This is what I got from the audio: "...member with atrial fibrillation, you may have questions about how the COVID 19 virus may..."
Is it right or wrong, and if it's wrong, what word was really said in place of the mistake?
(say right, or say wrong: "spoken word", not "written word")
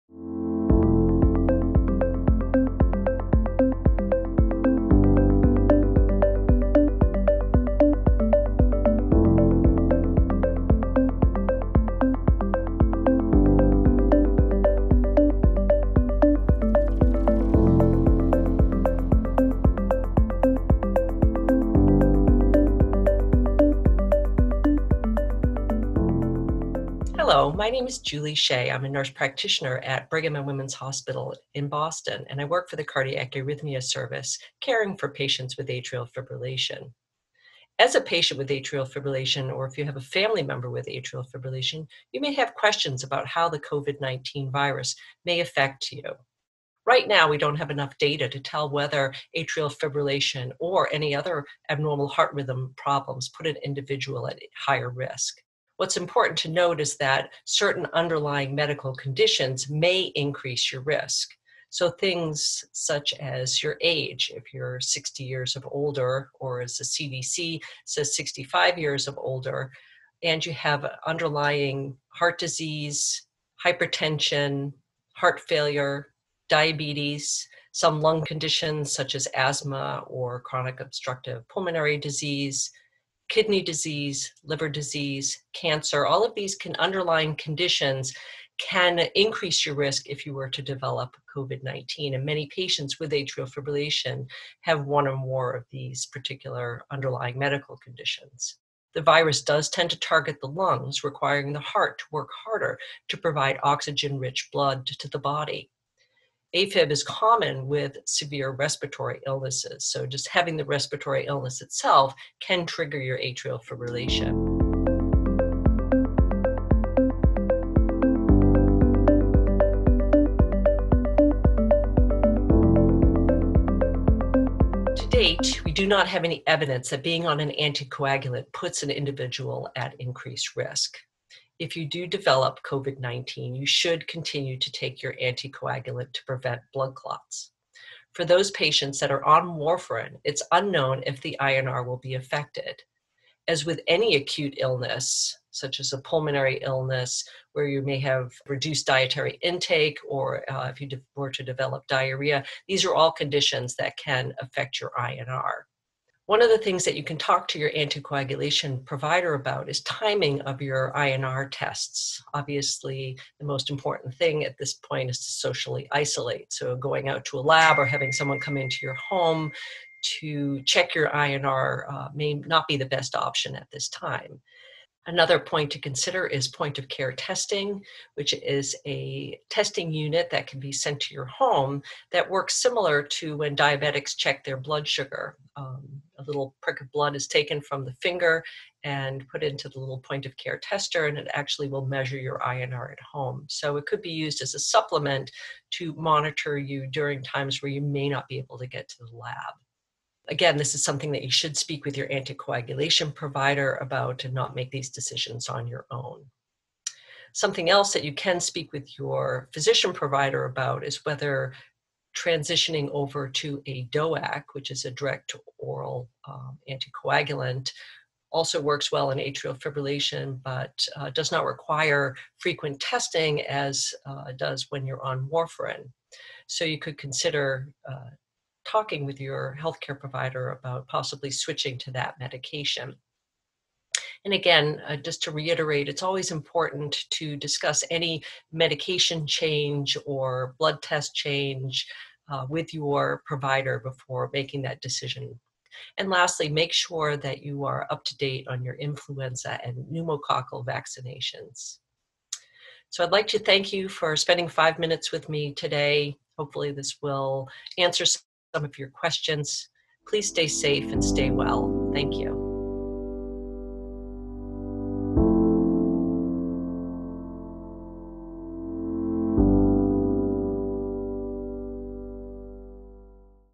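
right.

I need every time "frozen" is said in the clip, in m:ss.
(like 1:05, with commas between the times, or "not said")
not said.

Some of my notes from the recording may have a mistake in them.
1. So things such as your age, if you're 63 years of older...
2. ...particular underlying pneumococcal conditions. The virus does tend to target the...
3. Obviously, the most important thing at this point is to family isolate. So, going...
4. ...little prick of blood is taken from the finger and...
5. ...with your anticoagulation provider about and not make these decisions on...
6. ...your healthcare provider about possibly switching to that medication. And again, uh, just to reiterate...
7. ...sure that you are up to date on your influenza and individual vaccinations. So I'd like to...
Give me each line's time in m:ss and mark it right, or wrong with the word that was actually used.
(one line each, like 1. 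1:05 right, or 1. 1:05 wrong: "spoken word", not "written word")
1. 1:01 wrong: "60", not "63"
2. 1:36 wrong: "medical", not "pneumococcal"
3. 2:42 wrong: "socially", not "family"
4. 3:06 right
5. 3:21 right
6. 3:49 right
7. 4:06 wrong: "pneumococcal", not "individual".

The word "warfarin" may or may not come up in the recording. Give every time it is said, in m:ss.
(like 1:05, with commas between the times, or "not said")
2:19, 3:45.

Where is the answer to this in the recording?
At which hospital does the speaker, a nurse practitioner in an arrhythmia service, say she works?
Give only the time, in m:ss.
0:30.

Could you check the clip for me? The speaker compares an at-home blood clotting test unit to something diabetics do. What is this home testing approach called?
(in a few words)
Point of care testing.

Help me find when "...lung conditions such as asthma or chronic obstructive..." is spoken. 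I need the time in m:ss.
1:18.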